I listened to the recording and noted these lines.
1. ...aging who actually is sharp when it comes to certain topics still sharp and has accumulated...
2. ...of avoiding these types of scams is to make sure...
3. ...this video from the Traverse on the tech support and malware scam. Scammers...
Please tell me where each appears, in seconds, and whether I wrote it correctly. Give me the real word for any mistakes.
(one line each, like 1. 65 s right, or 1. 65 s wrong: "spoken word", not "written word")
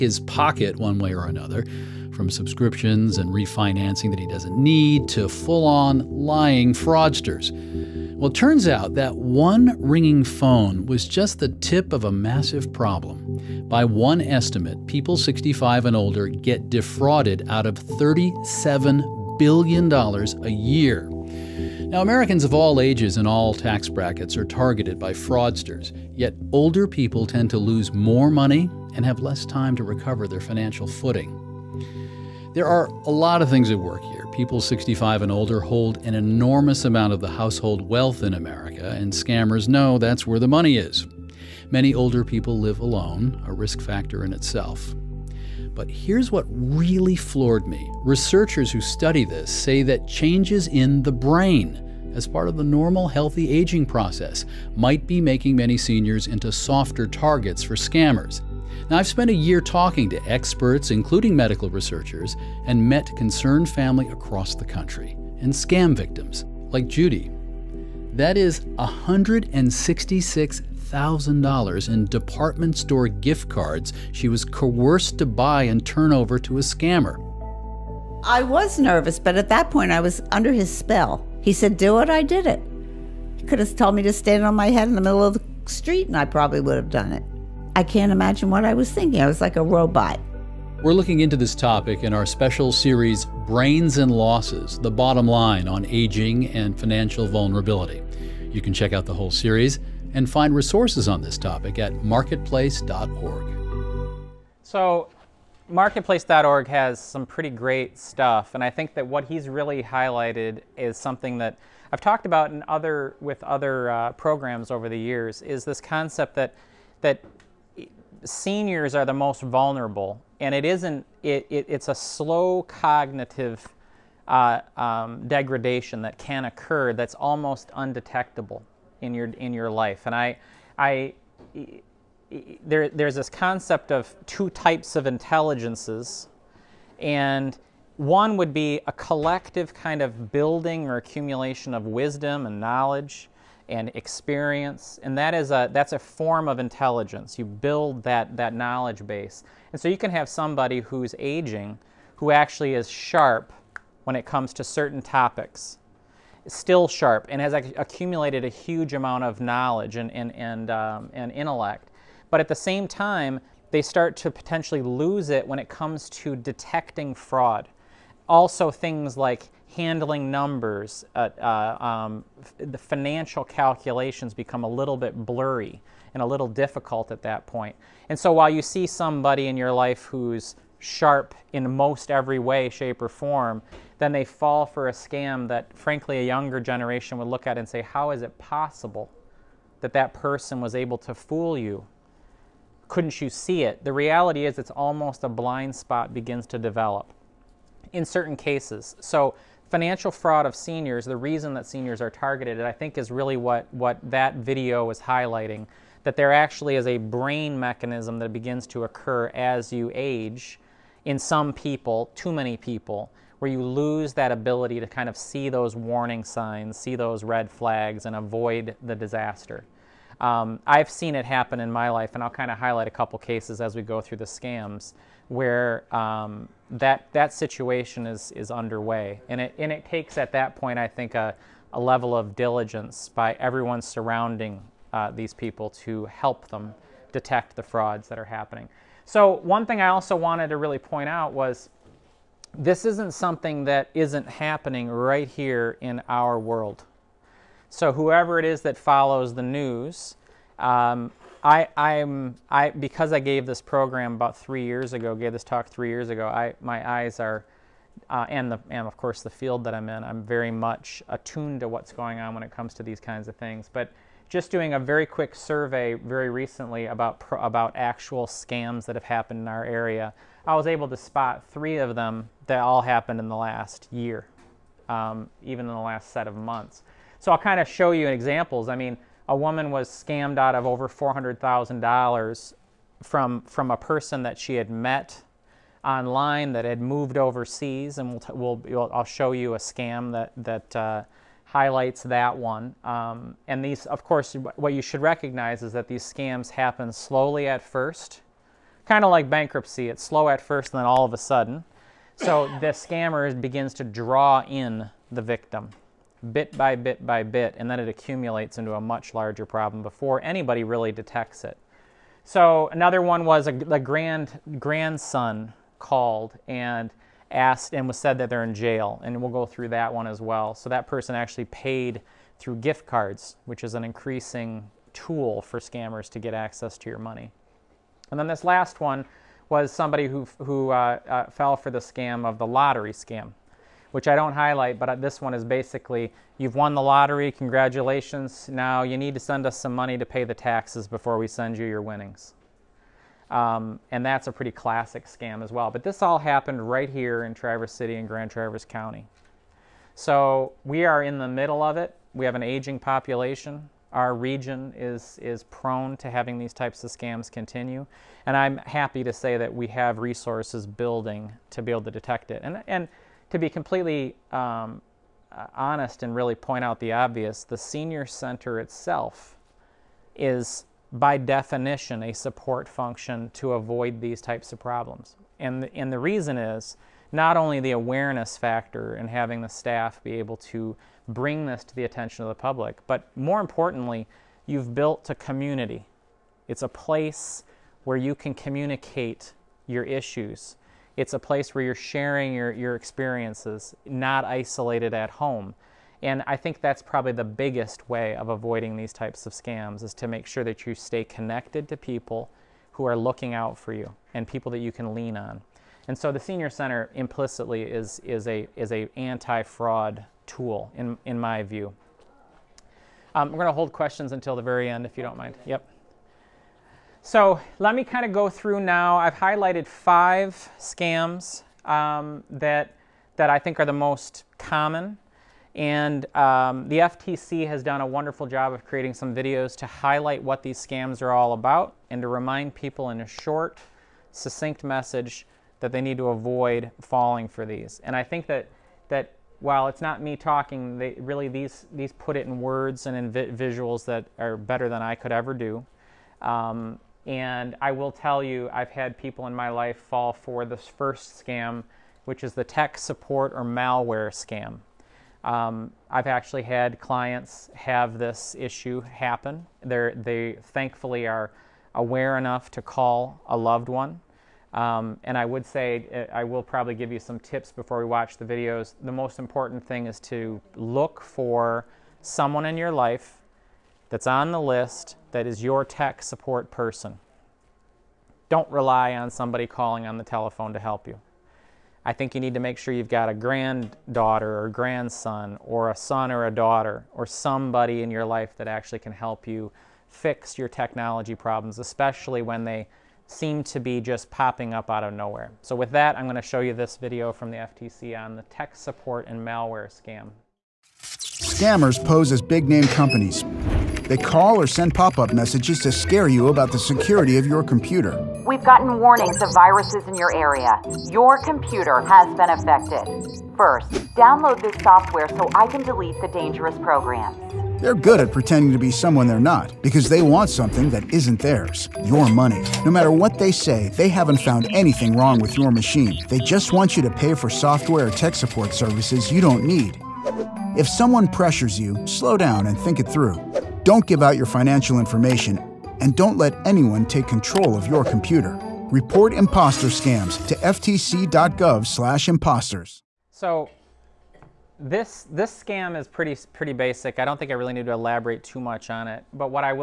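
1. 151 s right
2. 398 s right
3. 496 s wrong: "FTC", not "Traverse".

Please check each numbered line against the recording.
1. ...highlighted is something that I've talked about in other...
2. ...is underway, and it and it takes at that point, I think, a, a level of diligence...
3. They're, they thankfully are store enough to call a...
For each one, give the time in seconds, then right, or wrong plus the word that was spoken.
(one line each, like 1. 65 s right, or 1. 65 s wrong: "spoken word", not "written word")
1. 109 s right
2. 228 s right
3. 459 s wrong: "aware", not "store".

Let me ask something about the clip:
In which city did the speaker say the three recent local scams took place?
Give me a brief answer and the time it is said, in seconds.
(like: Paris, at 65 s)
Traverse City, at 347 s.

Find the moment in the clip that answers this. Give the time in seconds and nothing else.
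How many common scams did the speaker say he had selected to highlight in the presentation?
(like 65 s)
419 s.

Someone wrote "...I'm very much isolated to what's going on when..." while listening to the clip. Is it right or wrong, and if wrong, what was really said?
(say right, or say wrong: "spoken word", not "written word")
wrong: "attuned", not "isolated".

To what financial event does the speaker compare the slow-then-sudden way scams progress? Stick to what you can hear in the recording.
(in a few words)
Bankruptcy.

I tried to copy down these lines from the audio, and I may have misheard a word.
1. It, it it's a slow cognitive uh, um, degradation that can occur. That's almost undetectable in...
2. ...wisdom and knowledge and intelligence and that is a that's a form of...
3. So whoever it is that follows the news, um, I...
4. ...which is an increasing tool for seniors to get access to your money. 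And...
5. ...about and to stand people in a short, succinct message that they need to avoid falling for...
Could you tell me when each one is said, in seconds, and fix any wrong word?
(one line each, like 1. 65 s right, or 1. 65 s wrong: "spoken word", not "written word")
1. 121 s right
2. 141 s wrong: "experience", not "intelligence"
3. 247 s right
4. 323 s wrong: "scammers", not "seniors"
5. 431 s wrong: "remind", not "stand".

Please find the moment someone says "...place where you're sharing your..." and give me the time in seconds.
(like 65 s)
391 s.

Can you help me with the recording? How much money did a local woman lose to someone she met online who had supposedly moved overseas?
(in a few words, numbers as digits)
Over $400,000.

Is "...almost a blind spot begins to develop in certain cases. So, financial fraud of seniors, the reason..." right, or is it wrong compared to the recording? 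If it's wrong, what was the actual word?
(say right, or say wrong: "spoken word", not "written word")
right.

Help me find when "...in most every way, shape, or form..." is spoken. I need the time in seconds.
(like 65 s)
181 s.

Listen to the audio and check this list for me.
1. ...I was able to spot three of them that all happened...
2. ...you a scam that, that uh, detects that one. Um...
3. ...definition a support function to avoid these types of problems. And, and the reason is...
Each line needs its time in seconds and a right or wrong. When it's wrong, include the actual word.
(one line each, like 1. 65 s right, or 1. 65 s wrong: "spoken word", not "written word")
1. 270 s right
2. 289 s wrong: "highlights", not "detects"
3. 371 s right.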